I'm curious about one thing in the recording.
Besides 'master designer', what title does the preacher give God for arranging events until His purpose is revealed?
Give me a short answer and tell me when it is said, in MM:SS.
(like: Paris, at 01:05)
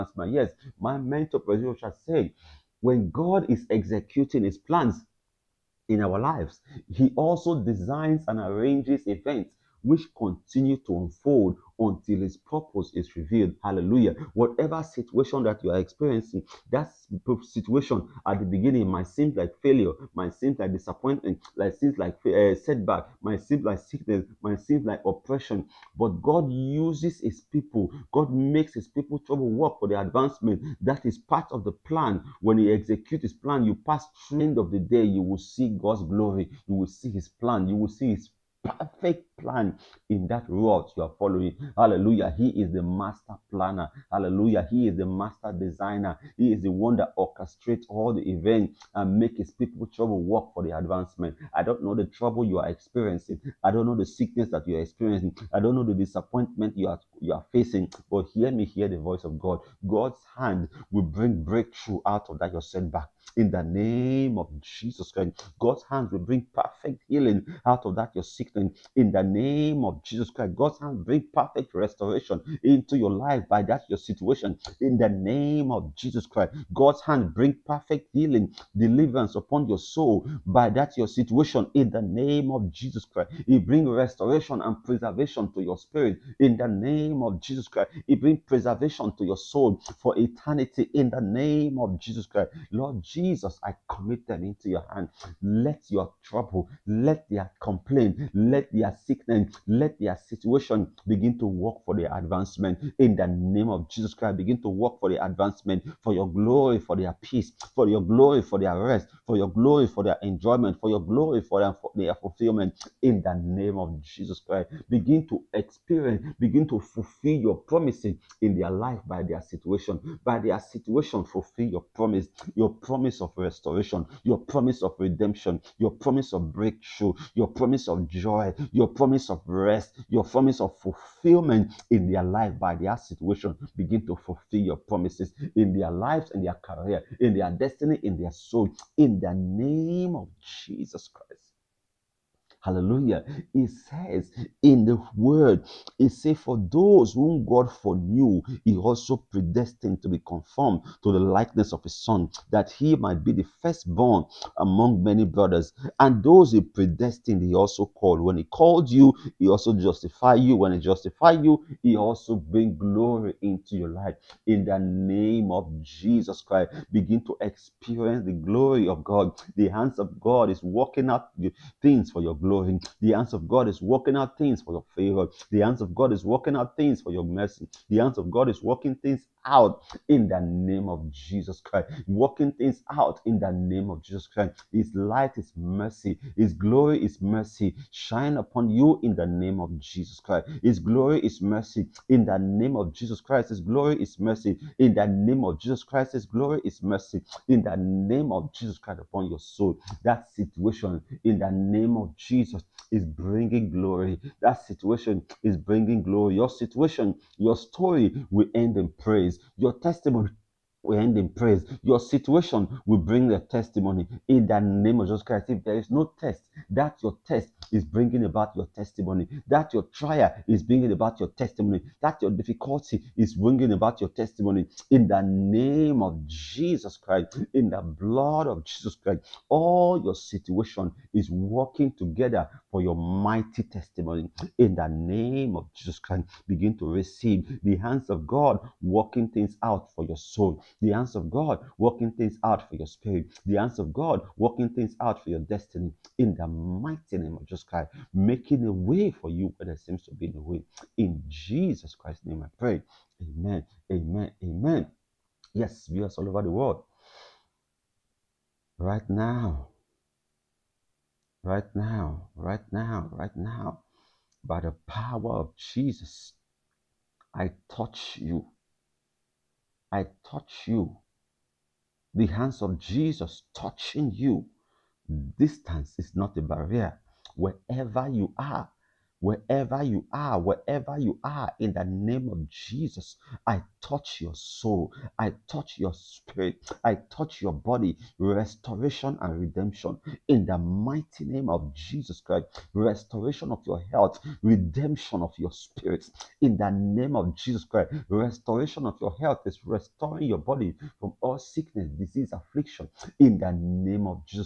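master planner, at 00:42.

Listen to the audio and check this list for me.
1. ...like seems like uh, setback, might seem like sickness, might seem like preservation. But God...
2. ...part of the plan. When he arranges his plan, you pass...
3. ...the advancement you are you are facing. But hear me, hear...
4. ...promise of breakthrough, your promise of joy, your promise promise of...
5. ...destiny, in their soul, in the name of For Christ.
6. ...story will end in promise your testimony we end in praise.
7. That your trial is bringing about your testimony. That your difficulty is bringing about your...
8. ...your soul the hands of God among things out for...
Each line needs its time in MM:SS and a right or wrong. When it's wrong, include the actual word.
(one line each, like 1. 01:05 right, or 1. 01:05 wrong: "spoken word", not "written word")
1. 00:21 wrong: "oppression", not "preservation"
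2. 00:31 wrong: "executes", not "arranges"
3. 00:55 wrong: "disappointment", not "advancement"
4. 02:05 right
5. 02:17 wrong: "Jesus", not "For"
6. 03:27 wrong: "praise", not "promise"
7. 03:39 right
8. 04:00 wrong: "working", not "among".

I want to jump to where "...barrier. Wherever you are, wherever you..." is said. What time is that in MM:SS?
04:36.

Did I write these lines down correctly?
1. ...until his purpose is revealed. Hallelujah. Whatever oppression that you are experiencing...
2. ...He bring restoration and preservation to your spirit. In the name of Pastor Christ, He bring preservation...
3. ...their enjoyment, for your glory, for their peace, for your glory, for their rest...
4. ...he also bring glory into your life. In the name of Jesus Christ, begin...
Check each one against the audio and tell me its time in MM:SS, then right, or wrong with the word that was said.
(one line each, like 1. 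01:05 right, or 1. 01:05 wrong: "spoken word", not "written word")
1. 00:11 wrong: "situation", not "oppression"
2. 01:23 wrong: "Jesus", not "Pastor"
3. 01:45 wrong: "advancement", not "enjoyment"
4. 02:41 right.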